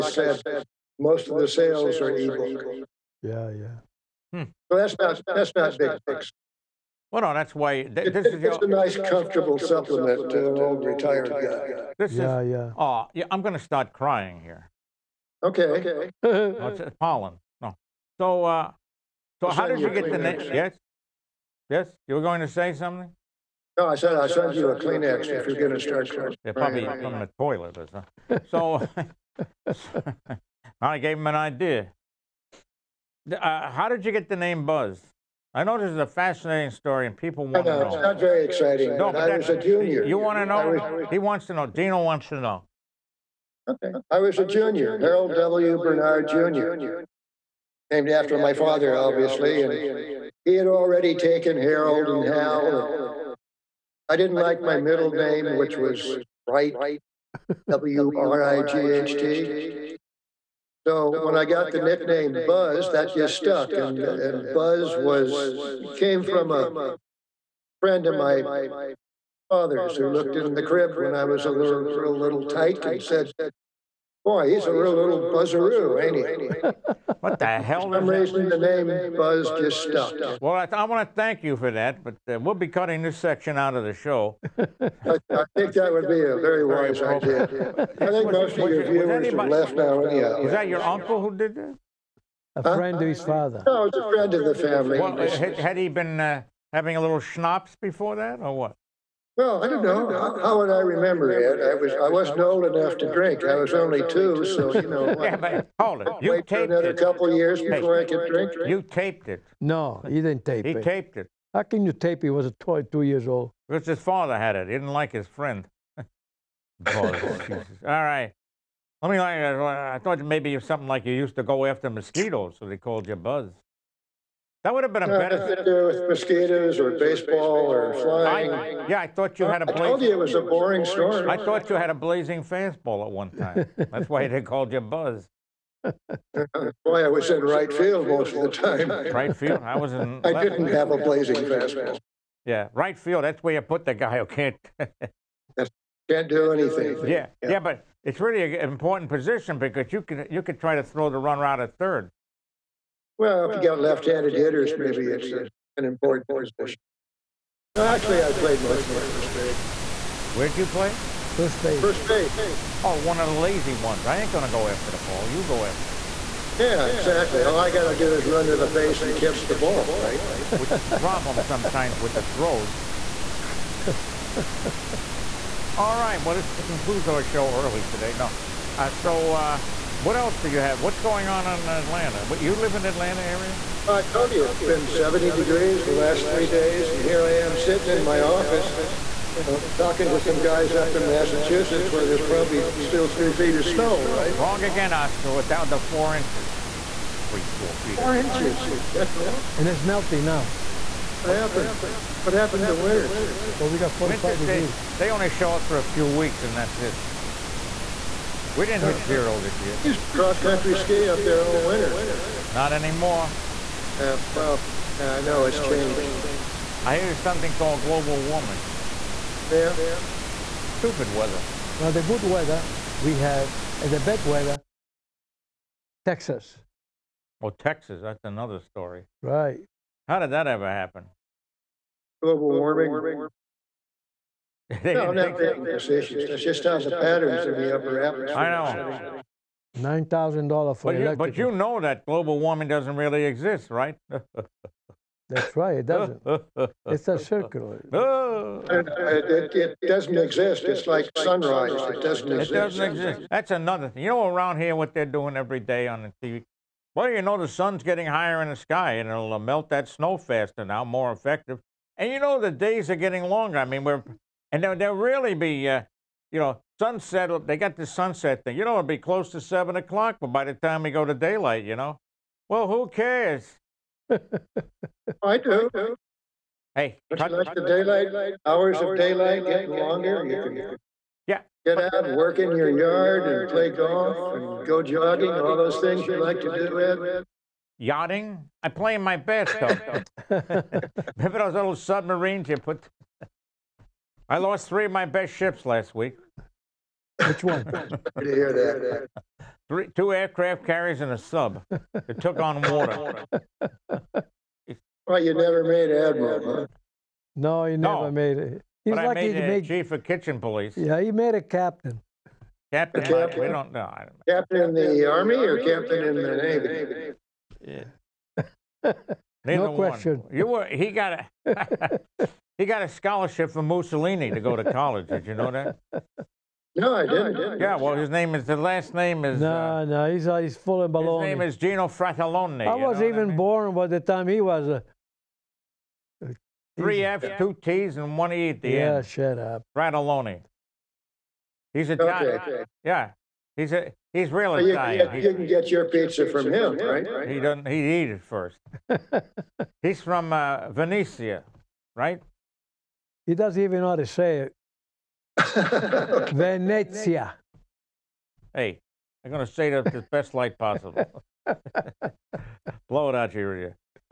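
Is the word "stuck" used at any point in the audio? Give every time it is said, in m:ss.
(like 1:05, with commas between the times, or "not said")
1:03, 1:19.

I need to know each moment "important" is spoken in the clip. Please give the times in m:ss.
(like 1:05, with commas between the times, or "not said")
2:28, 2:35.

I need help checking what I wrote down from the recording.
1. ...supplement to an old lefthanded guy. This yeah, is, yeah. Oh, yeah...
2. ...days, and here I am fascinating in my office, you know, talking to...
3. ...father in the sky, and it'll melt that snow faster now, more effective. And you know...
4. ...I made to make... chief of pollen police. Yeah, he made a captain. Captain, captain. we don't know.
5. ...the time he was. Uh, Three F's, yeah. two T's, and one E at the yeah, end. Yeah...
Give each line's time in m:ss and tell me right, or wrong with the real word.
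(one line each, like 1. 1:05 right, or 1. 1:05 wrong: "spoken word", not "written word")
1. 0:09 wrong: "retired", not "lefthanded"
2. 3:06 wrong: "sitting", not "fascinating"
3. 4:18 wrong: "higher", not "father"
4. 5:09 wrong: "kitchen", not "pollen"
5. 5:33 right.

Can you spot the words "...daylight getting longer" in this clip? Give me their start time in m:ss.
4:39.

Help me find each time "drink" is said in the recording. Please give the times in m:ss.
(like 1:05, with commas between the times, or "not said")
1:43, 1:48.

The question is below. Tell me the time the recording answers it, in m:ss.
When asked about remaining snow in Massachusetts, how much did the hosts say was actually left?
3:15.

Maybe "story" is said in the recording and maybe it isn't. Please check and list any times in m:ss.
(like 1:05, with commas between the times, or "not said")
0:36, 2:10, 3:48.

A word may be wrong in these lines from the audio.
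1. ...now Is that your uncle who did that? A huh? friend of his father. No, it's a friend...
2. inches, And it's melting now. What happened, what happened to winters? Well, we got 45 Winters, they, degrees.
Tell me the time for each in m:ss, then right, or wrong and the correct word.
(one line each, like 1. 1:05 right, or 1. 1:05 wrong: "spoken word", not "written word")
1. 1:29 right
2. 3:18 right.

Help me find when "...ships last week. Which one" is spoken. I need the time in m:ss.
4:55.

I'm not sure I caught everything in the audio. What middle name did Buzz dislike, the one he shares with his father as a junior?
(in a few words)
Wright.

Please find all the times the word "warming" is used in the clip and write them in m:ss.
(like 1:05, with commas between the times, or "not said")
3:38, 3:52, 4:02.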